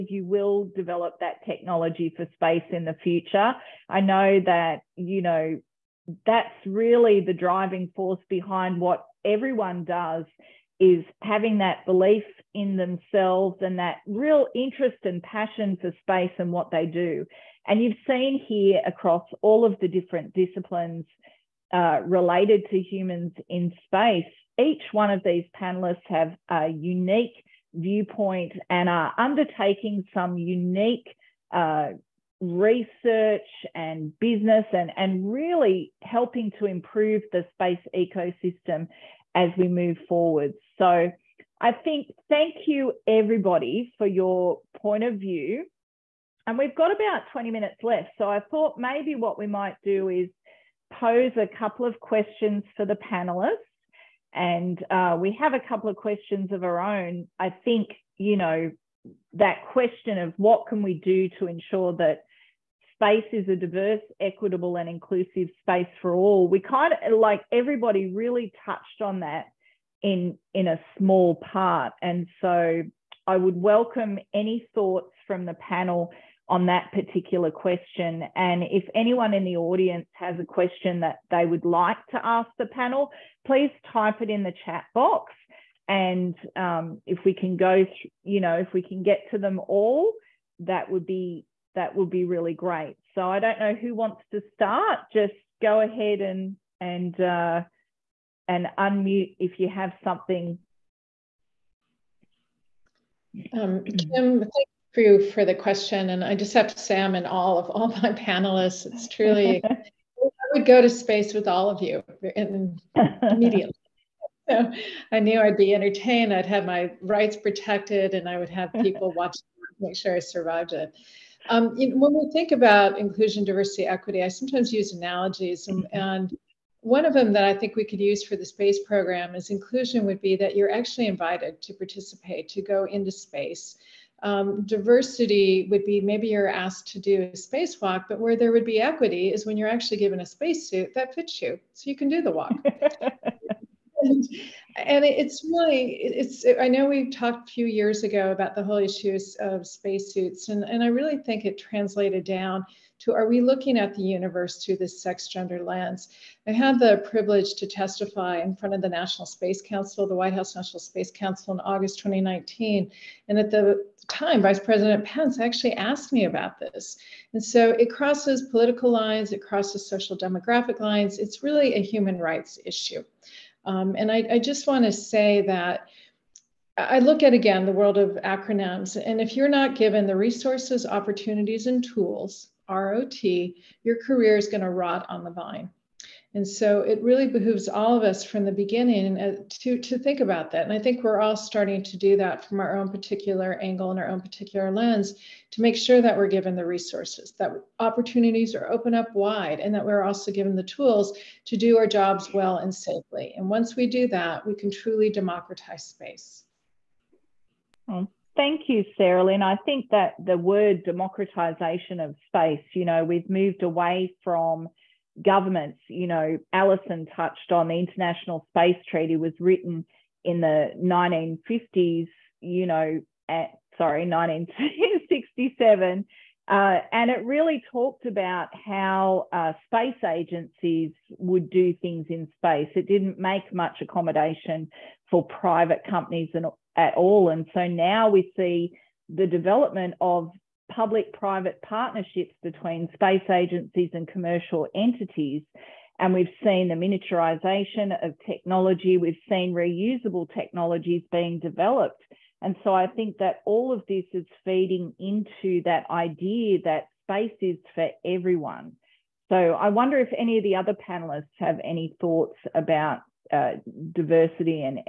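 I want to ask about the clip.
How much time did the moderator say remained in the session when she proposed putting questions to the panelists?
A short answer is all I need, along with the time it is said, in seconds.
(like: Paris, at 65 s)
20 minutes, at 47 s.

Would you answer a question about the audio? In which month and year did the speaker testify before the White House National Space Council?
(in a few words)
August 2019.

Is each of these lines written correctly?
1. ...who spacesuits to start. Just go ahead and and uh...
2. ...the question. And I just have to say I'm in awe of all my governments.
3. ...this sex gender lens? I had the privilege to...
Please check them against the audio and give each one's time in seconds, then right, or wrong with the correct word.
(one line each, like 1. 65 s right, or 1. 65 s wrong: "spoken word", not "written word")
1. 93 s wrong: "wants", not "spacesuits"
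2. 105 s wrong: "panelists", not "governments"
3. 154 s right.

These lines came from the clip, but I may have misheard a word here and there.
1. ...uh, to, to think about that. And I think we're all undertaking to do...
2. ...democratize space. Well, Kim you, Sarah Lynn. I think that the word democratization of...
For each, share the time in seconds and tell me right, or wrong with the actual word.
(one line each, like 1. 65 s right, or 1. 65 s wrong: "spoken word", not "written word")
1. 189 s wrong: "starting", not "undertaking"
2. 205 s wrong: "Thank", not "Kim".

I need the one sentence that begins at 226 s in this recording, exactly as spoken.
Uh, and it really talked about how uh, space agencies would do things in space.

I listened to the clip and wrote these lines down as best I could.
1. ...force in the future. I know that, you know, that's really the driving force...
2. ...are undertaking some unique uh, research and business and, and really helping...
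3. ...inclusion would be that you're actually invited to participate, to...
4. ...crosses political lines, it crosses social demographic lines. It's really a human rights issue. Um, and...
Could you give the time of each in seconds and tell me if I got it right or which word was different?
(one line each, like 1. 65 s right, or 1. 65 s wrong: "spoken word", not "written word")
1. 2 s wrong: "space", not "force"
2. 28 s right
3. 129 s right
4. 167 s right.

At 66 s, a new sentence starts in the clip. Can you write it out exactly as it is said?
We kind of like everybody really touched on that in in a small part.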